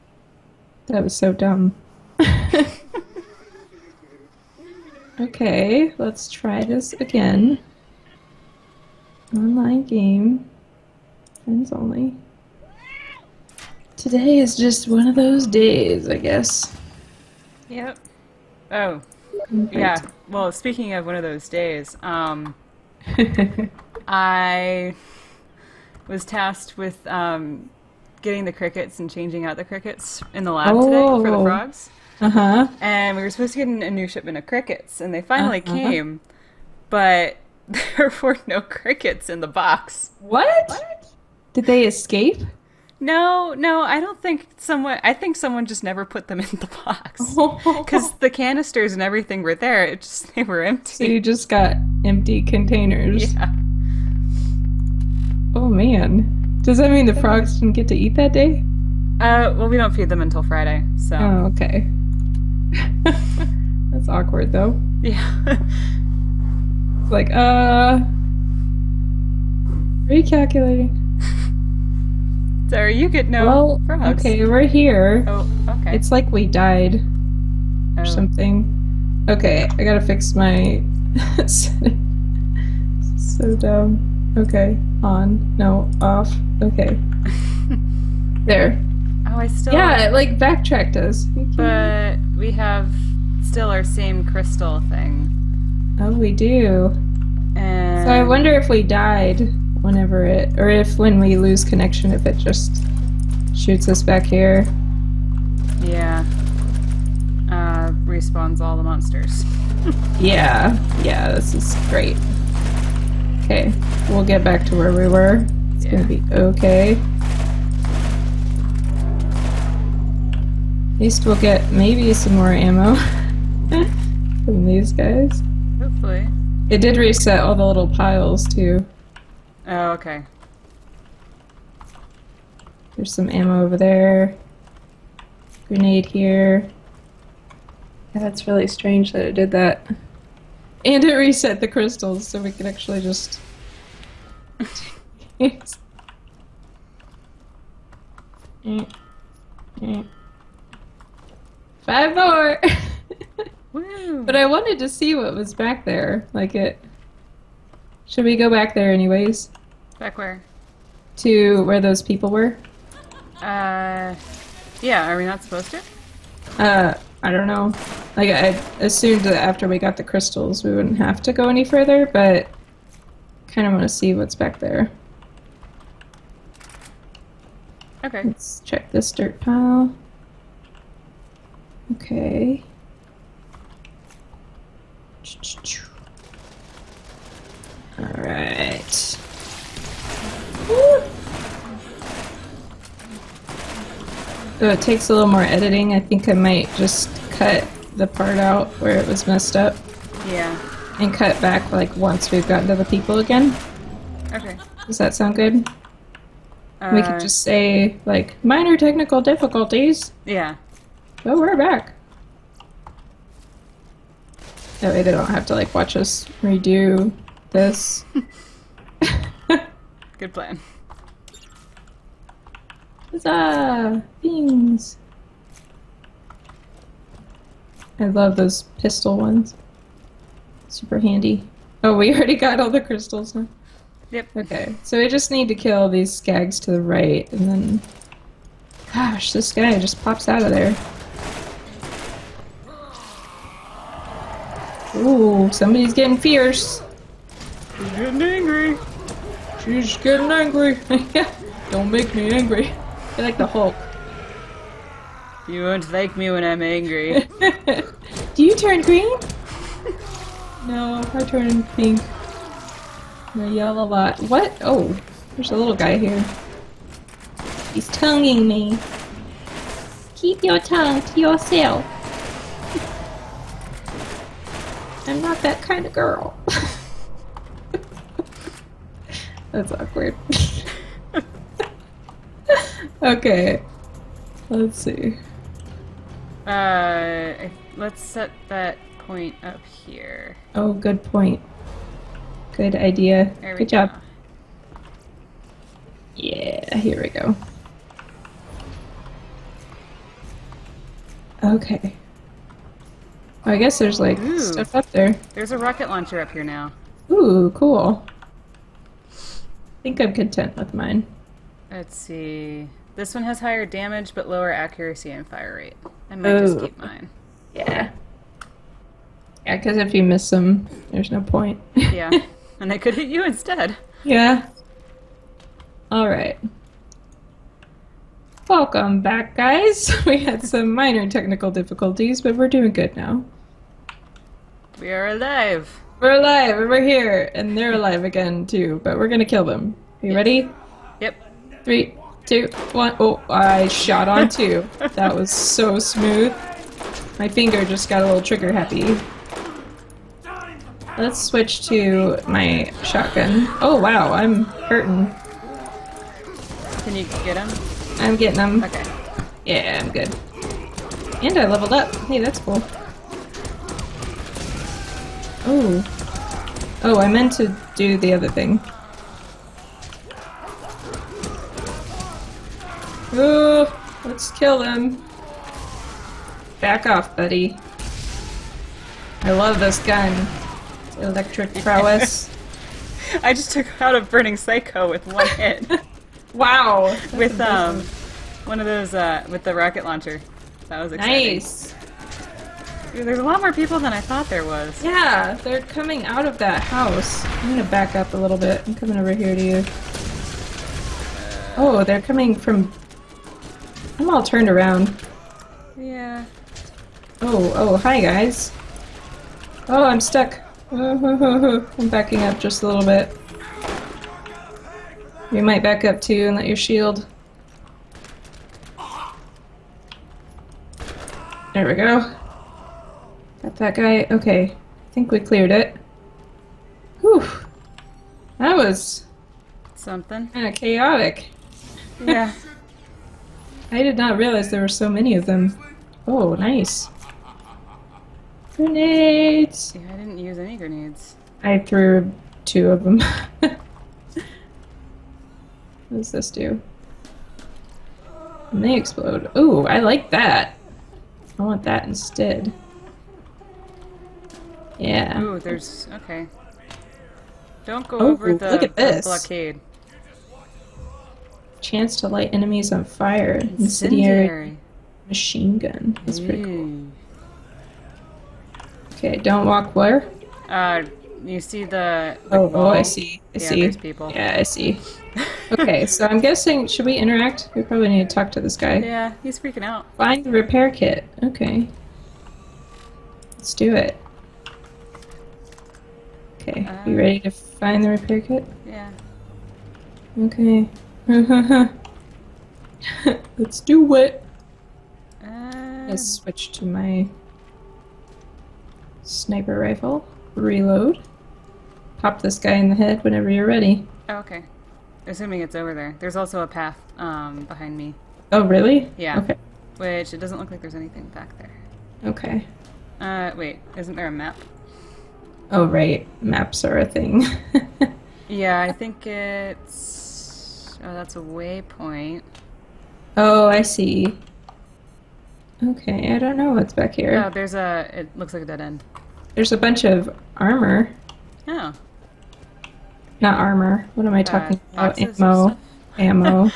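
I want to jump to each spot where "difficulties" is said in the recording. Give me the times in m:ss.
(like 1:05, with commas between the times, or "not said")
3:29, 5:31.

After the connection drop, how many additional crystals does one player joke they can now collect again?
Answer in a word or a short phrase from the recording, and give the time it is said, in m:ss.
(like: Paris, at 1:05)
5, at 2:31.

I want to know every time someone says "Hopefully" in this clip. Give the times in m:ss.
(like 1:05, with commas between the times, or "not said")
2:05.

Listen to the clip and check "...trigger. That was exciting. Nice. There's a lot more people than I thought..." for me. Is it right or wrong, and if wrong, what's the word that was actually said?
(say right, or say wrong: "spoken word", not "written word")
wrong: "launcher", not "trigger".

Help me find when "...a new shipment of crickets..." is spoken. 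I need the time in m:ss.
0:33.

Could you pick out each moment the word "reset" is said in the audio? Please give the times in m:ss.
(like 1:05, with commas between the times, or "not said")
2:06, 2:21.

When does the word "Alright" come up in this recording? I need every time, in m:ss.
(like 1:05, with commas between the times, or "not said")
3:07, 5:25.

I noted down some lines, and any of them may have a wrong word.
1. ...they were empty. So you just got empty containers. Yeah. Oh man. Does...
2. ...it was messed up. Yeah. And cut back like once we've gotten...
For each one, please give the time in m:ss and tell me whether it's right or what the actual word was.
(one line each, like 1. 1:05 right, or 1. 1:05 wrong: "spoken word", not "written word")
1. 0:50 right
2. 3:18 right.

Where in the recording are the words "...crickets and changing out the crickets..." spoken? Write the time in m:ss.
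0:28.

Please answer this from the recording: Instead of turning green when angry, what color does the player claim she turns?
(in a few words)
Pink.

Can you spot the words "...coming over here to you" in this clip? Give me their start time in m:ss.
6:38.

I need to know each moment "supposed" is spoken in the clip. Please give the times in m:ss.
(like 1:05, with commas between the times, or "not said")
0:33, 2:45.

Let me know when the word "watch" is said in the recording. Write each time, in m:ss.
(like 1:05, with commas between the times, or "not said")
3:35.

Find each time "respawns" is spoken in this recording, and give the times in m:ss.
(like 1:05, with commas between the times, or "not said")
1:48.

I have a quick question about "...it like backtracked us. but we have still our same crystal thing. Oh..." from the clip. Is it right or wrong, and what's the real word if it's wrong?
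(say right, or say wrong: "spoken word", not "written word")
right.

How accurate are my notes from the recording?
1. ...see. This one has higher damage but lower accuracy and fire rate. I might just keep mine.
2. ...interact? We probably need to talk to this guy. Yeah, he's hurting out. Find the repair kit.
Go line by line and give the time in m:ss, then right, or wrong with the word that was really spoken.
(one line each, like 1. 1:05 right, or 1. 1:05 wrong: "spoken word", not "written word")
1. 5:11 right
2. 7:56 wrong: "freaking", not "hurting".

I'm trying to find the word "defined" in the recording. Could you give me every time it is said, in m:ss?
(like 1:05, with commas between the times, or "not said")
not said.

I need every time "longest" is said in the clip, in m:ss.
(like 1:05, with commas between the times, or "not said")
not said.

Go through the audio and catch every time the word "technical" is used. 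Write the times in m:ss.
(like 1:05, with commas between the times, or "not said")
3:28, 5:31.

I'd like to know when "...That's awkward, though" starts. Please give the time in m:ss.
1:03.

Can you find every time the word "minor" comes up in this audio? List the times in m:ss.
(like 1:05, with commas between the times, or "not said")
3:28, 5:30.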